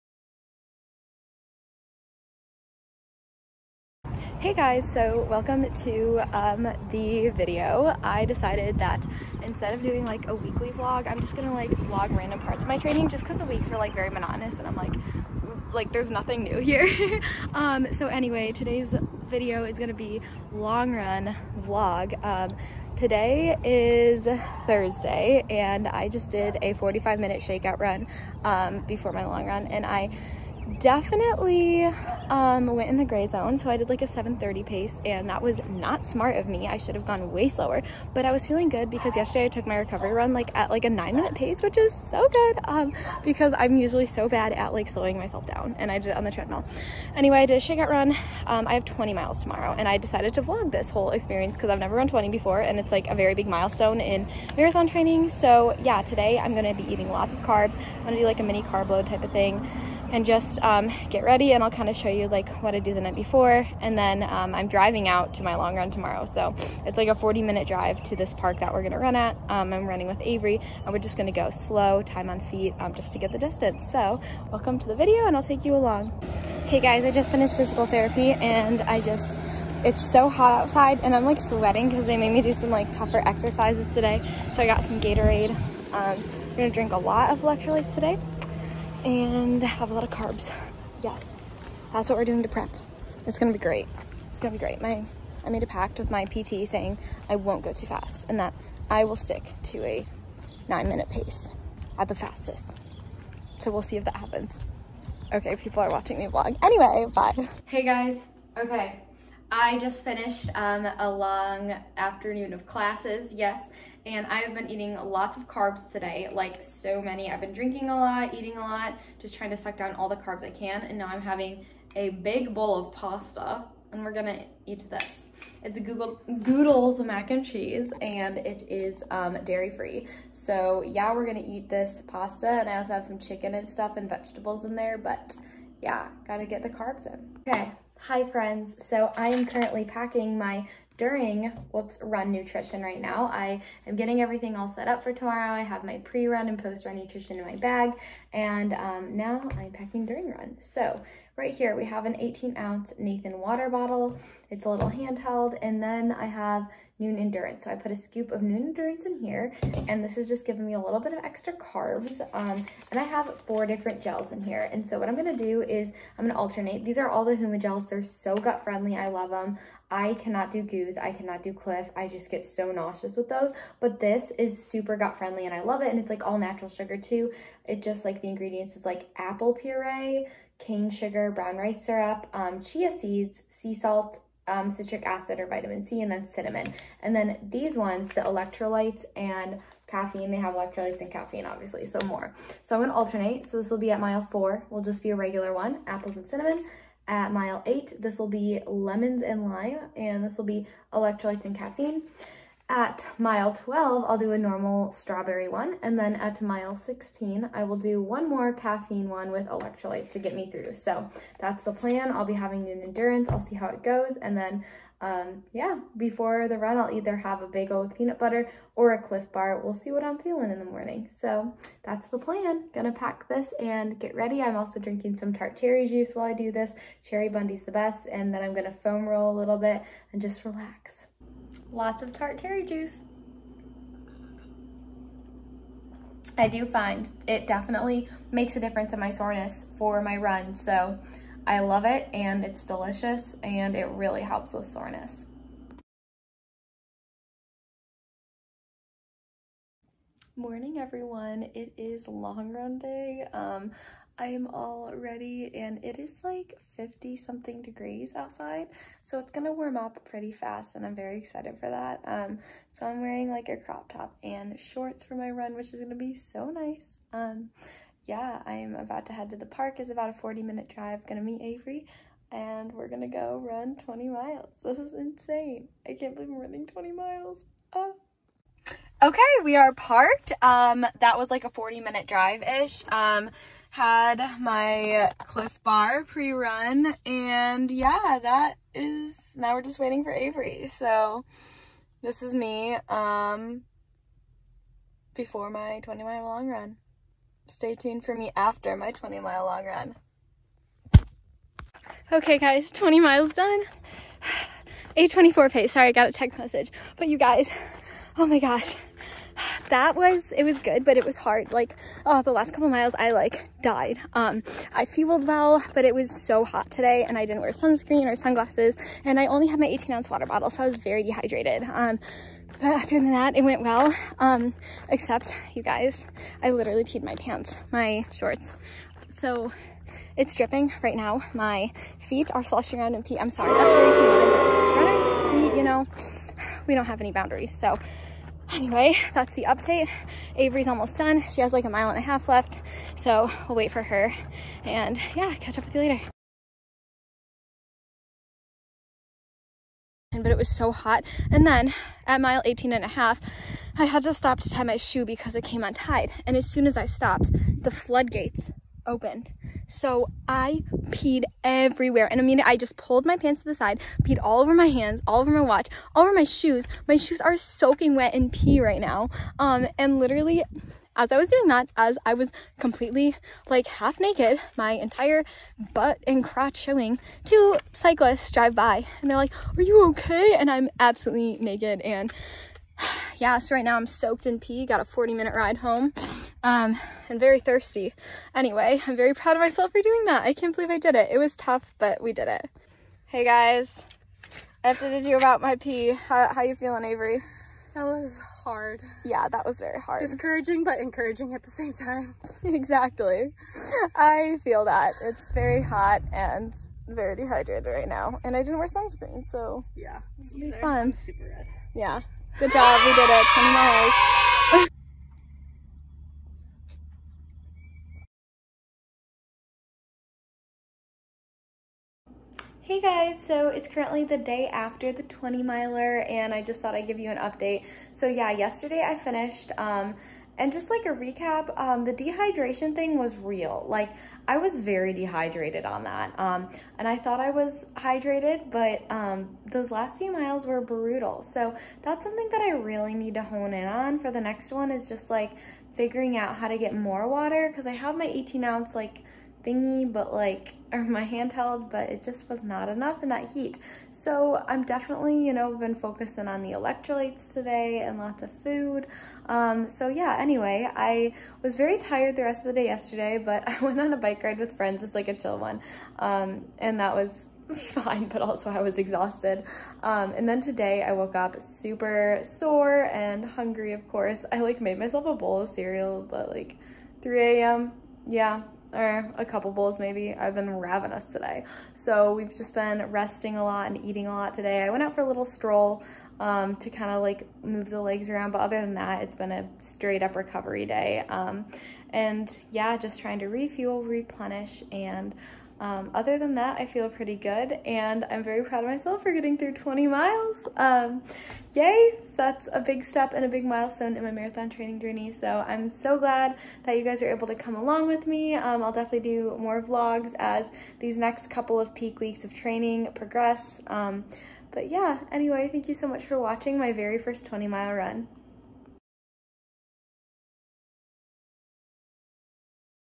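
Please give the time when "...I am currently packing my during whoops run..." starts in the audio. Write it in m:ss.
2:19.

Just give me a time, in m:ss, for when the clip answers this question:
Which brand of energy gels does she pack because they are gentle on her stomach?
2:47.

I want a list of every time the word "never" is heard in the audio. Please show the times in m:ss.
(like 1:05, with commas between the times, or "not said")
0:51.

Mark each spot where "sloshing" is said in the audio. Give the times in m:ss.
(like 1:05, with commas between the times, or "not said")
5:32.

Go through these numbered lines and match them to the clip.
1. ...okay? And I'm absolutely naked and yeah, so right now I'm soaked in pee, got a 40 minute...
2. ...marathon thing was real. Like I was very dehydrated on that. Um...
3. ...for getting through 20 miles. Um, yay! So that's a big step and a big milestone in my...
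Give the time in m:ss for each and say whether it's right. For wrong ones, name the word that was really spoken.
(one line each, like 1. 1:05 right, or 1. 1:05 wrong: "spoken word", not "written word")
1. 6:19 right
2. 7:11 wrong: "dehydration", not "marathon"
3. 8:19 right.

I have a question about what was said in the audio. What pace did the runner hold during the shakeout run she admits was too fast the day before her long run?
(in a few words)
7:30.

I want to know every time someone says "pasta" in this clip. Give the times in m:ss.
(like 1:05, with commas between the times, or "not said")
2:02, 2:12.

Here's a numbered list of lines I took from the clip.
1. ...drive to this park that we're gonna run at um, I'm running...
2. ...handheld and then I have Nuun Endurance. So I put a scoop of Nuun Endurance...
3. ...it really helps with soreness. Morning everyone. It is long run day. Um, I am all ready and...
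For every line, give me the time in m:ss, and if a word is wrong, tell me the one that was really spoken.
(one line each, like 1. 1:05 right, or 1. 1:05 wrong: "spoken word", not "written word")
1. 1:07 right
2. 2:34 right
3. 4:03 right.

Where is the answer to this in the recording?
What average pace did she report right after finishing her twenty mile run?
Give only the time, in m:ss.
5:04.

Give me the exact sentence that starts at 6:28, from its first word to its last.
Anyway, I'm very proud of myself for doing that.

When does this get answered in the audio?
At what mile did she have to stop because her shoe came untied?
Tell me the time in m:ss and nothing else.
5:52.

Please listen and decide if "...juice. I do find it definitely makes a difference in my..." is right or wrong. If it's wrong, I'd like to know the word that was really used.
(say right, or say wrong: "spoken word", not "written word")
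right.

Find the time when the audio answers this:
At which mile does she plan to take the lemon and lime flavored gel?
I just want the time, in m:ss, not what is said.
3:17.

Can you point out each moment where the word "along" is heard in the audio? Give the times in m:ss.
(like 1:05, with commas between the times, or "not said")
1:15, 8:27.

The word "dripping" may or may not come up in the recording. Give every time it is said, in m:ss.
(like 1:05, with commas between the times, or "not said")
5:30.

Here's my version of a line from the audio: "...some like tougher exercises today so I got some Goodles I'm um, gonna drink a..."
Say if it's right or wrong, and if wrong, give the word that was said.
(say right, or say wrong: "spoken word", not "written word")
wrong: "Gatorade", not "Goodles".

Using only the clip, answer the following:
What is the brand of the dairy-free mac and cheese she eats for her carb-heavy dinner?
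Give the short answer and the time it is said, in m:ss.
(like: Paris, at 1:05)
Goodles, at 2:06.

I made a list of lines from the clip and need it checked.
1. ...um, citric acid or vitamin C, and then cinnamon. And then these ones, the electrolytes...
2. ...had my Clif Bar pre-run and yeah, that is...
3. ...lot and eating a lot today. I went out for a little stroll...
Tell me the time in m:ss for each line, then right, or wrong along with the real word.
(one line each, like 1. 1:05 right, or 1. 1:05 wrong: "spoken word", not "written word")
1. 3:04 right
2. 4:43 right
3. 8:03 right.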